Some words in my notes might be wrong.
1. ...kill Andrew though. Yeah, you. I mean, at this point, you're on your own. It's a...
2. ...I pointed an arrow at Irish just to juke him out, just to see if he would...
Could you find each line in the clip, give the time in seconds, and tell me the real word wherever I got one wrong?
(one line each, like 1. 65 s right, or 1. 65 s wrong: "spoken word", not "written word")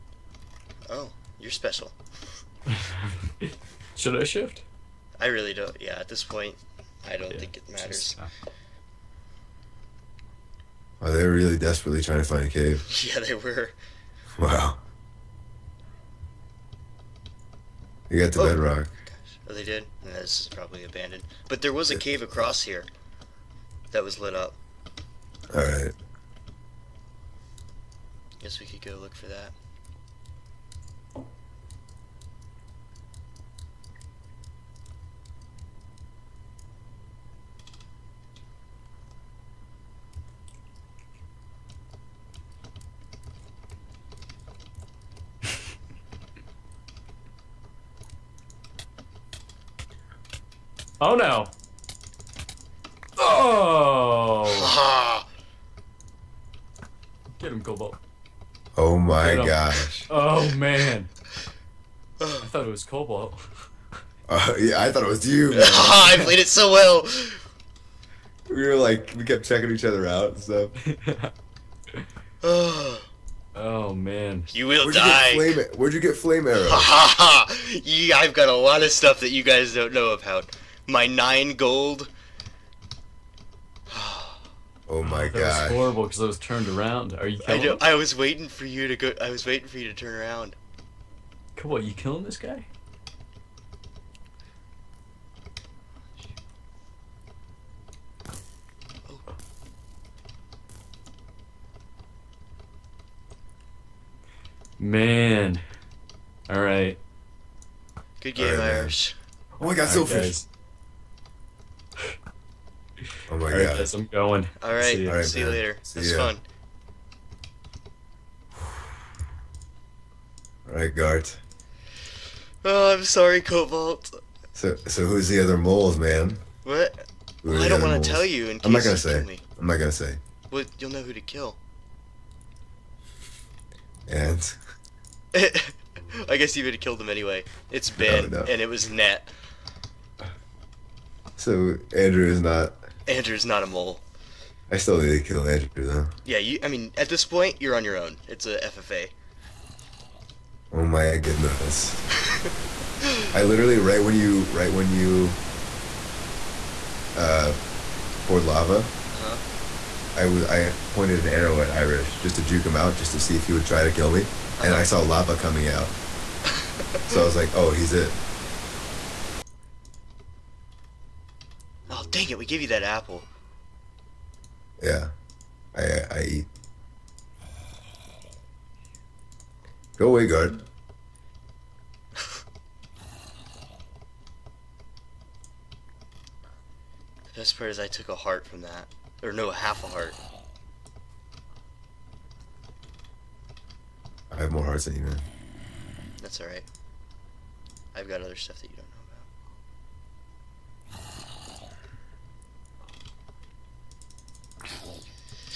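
1. 145 s right
2. 160 s right.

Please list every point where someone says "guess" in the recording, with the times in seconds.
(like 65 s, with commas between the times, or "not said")
28 s, 136 s.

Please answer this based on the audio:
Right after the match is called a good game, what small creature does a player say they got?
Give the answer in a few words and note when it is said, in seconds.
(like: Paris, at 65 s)
Silverfish, at 109 s.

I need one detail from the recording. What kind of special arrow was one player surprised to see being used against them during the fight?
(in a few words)
Flame arrow.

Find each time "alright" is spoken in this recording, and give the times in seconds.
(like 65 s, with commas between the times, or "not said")
25 s, 106 s, 196 s.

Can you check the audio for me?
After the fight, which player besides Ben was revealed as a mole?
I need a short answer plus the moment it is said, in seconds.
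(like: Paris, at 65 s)
Nat, at 138 s.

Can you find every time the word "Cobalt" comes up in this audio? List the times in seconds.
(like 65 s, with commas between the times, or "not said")
57 s, 62 s, 123 s.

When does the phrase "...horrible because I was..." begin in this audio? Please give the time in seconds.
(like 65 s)
85 s.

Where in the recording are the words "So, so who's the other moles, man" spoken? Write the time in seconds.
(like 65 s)
124 s.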